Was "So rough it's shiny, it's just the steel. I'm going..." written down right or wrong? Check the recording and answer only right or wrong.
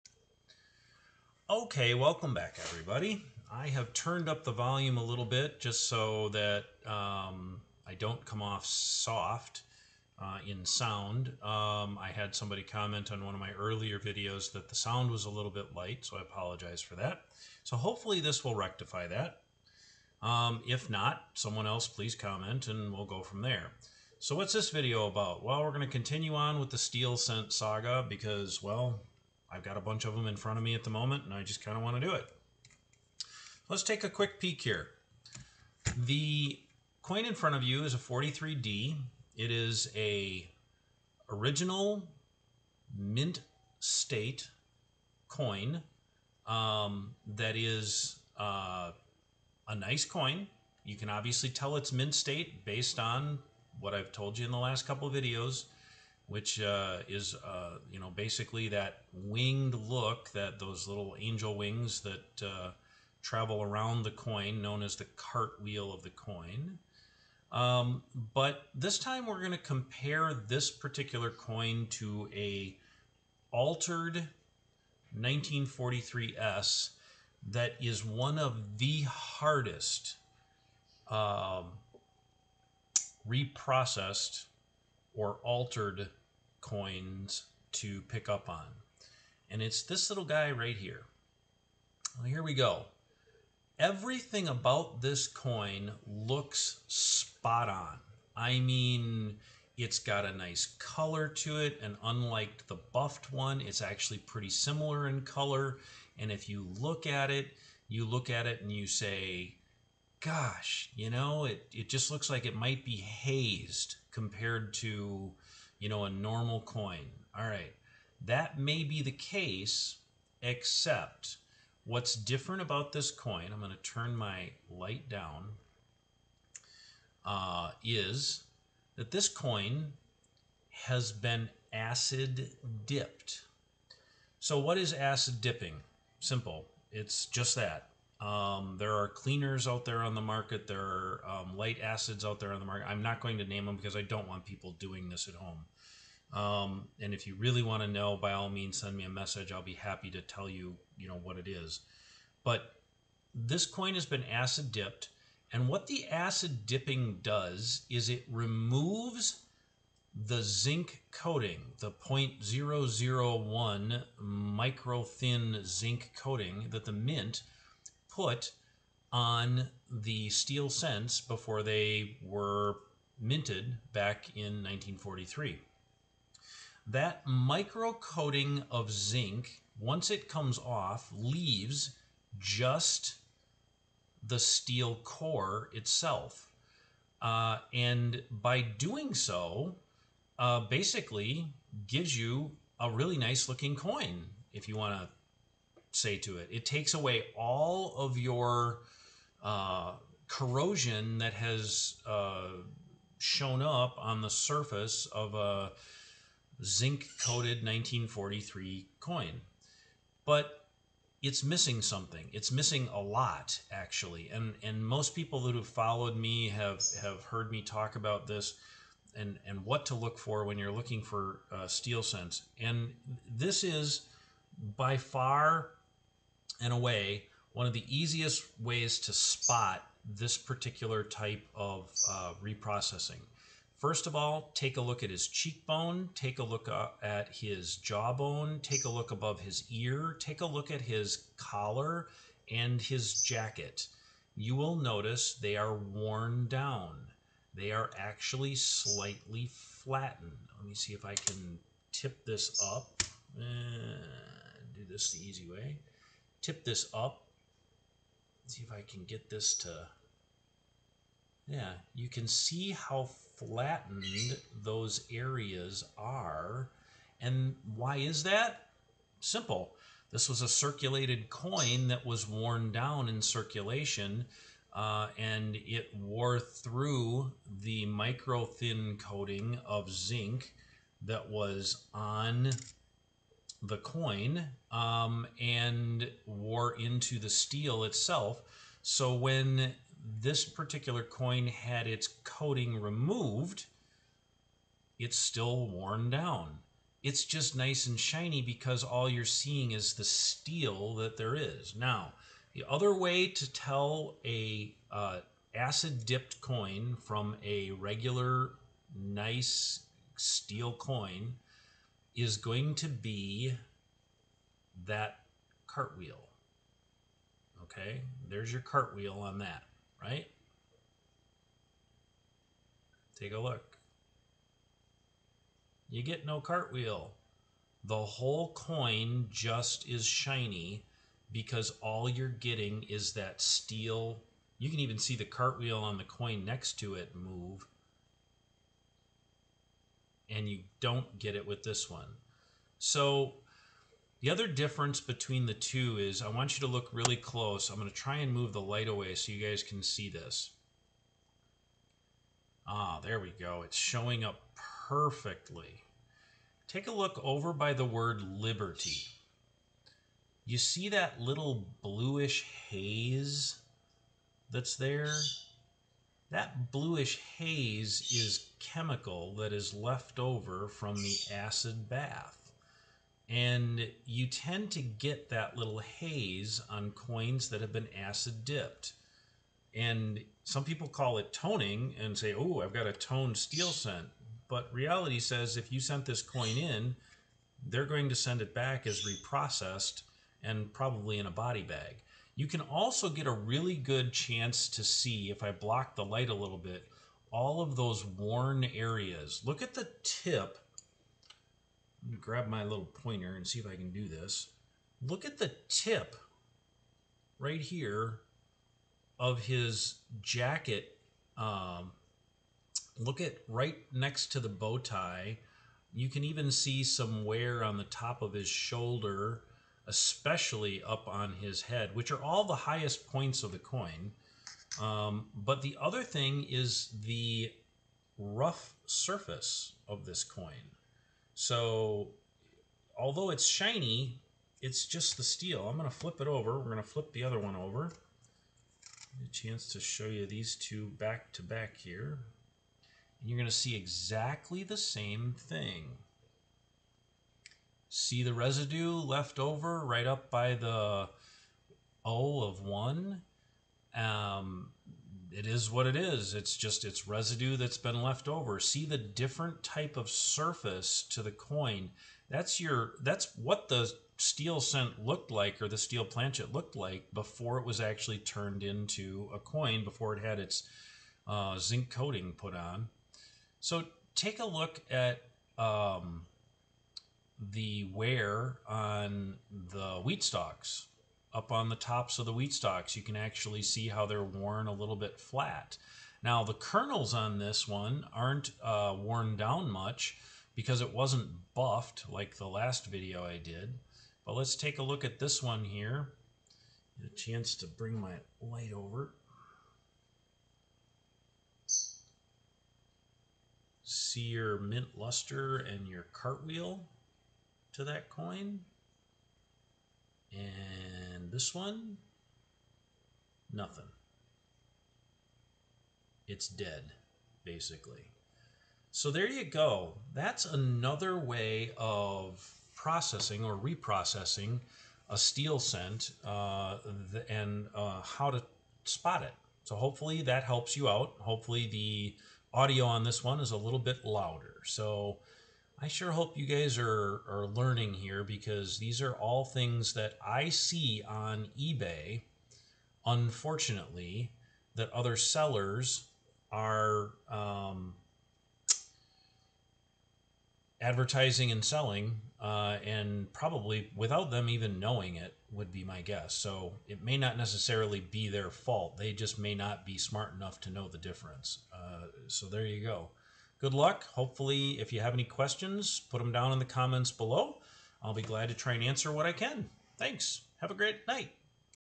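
wrong.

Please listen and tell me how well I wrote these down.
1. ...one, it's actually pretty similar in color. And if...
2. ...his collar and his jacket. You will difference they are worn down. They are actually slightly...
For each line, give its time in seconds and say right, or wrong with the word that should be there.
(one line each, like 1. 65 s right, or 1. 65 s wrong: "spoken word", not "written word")
1. 103 s right
2. 240 s wrong: "notice", not "difference".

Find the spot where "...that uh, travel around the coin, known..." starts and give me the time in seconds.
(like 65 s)
62 s.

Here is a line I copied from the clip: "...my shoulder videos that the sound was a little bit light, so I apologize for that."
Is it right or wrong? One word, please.
wrong.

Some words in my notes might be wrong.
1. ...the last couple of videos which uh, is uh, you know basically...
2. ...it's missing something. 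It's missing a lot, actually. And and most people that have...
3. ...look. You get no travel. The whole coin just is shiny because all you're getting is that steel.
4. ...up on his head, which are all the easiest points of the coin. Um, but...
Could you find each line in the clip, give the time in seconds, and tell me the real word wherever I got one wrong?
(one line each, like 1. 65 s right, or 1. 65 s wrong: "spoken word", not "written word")
1. 54 s right
2. 211 s right
3. 323 s wrong: "cartwheel", not "travel"
4. 420 s wrong: "highest", not "easiest".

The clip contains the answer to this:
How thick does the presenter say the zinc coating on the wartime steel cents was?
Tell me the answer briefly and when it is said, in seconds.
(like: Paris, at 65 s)
0.001, at 161 s.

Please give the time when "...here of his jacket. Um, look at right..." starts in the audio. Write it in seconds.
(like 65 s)
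407 s.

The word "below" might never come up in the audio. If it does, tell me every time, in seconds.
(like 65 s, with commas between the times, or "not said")
567 s.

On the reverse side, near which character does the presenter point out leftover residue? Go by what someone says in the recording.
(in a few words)
O of 1.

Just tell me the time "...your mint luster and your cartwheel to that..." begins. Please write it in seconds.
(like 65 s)
504 s.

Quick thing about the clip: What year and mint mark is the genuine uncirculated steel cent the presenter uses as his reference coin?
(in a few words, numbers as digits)
1943D.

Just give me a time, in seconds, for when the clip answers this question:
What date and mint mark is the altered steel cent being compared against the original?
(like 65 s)
75 s.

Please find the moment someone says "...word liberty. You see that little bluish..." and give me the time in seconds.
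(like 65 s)
357 s.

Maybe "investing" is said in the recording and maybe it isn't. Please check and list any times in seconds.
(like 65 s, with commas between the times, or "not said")
not said.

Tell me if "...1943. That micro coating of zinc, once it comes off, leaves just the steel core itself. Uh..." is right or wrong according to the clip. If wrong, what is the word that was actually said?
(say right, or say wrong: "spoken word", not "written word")
right.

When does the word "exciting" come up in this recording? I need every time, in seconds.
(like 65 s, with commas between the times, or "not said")
not said.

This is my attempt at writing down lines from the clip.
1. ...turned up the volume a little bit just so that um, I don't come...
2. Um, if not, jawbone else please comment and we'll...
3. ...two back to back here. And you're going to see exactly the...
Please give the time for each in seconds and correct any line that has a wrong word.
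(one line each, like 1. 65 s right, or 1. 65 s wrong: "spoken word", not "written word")
1. 3 s right
2. 20 s wrong: "someone", not "jawbone"
3. 440 s right.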